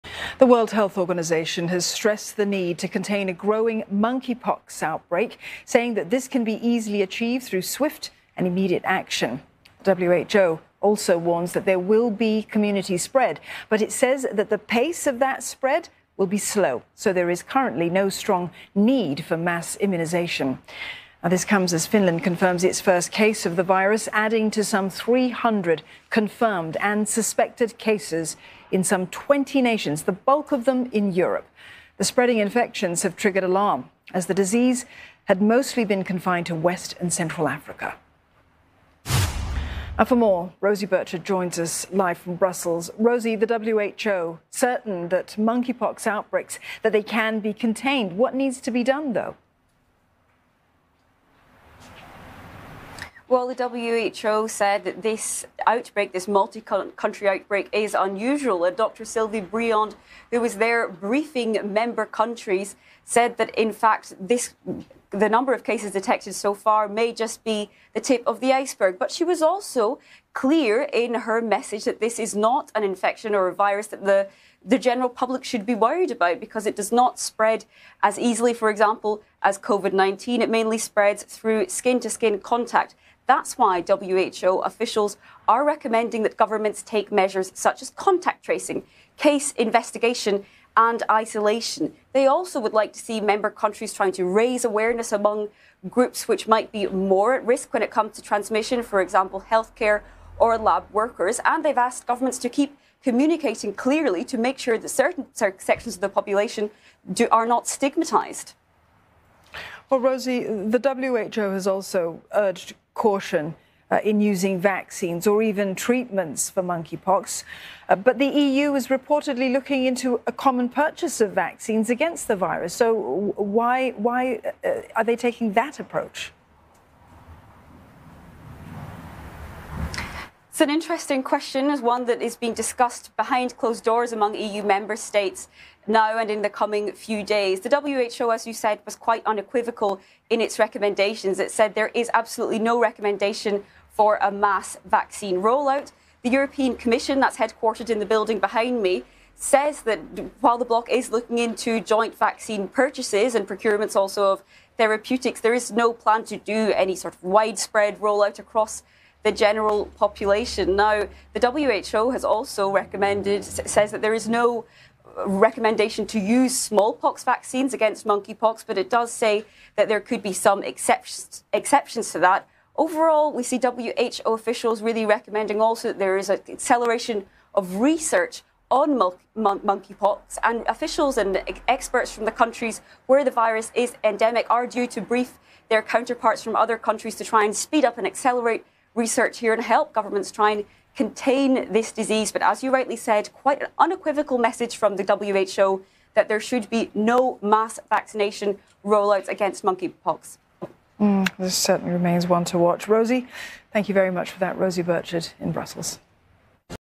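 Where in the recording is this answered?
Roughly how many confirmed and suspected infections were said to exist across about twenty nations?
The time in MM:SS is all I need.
00:24.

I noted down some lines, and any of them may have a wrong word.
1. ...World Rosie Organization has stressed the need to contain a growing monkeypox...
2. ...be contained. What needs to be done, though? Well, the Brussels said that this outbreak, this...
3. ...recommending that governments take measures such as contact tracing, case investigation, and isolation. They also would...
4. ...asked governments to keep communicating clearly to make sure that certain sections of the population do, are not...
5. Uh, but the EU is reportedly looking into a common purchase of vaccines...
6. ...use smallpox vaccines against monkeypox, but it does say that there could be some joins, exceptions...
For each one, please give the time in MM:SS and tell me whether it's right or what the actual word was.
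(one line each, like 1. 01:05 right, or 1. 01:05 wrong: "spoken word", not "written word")
1. 00:00 wrong: "Health", not "Rosie"
2. 00:47 wrong: "WHO", not "Brussels"
3. 01:25 right
4. 01:41 right
5. 01:57 right
6. 02:46 wrong: "exceptions", not "joins".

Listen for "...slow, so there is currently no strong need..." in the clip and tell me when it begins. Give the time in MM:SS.
00:16.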